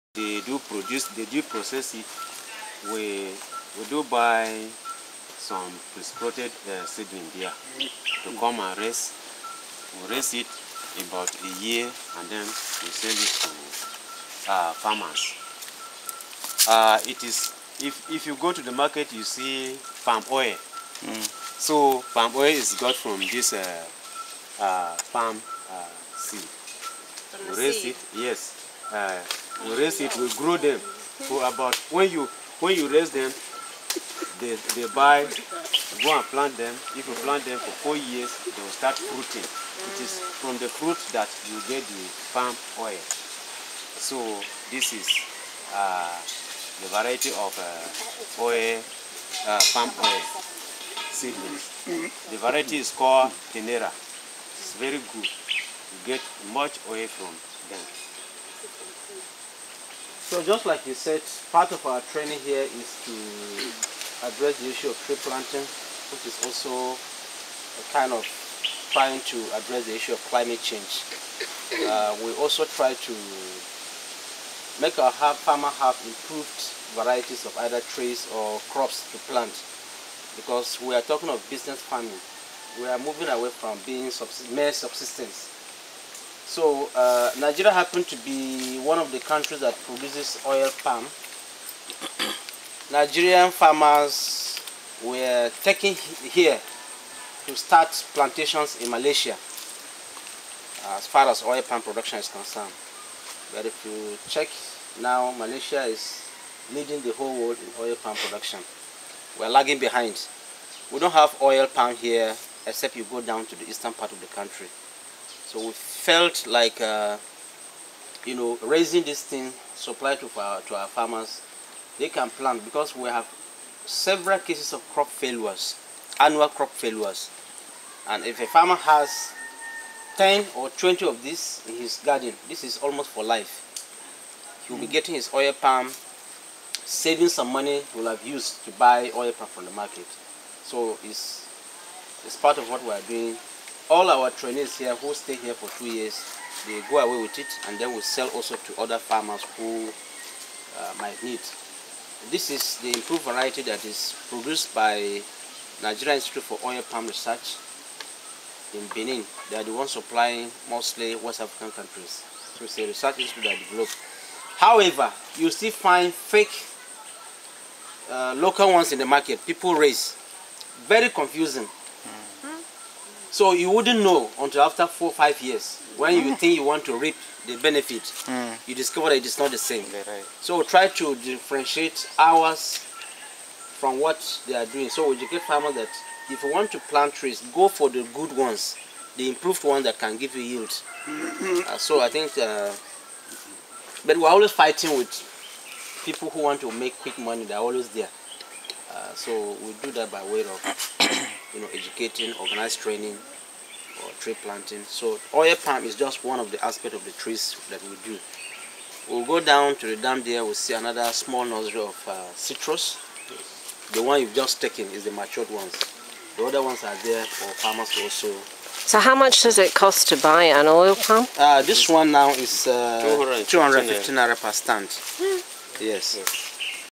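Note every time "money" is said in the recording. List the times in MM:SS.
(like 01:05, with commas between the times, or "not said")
02:17, 03:17.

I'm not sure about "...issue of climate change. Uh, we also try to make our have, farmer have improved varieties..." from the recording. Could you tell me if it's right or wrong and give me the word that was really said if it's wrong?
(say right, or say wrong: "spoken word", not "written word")
right.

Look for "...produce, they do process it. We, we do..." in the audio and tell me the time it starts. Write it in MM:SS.
00:00.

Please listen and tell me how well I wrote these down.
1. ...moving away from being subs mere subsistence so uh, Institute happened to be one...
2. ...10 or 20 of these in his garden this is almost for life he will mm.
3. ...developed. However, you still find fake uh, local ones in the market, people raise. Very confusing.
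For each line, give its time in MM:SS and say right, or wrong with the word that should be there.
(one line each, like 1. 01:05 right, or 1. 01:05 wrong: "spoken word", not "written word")
1. 01:22 wrong: "Nigeria", not "Institute"
2. 02:10 right
3. 02:43 right.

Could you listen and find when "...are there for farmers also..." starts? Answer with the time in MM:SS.
03:36.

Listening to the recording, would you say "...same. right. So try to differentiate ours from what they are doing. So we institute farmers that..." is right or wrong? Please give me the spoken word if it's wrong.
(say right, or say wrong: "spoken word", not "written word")
wrong: "educate", not "institute".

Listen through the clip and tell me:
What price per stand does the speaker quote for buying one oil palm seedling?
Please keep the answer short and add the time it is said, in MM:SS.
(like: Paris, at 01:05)
250 naira, at 03:43.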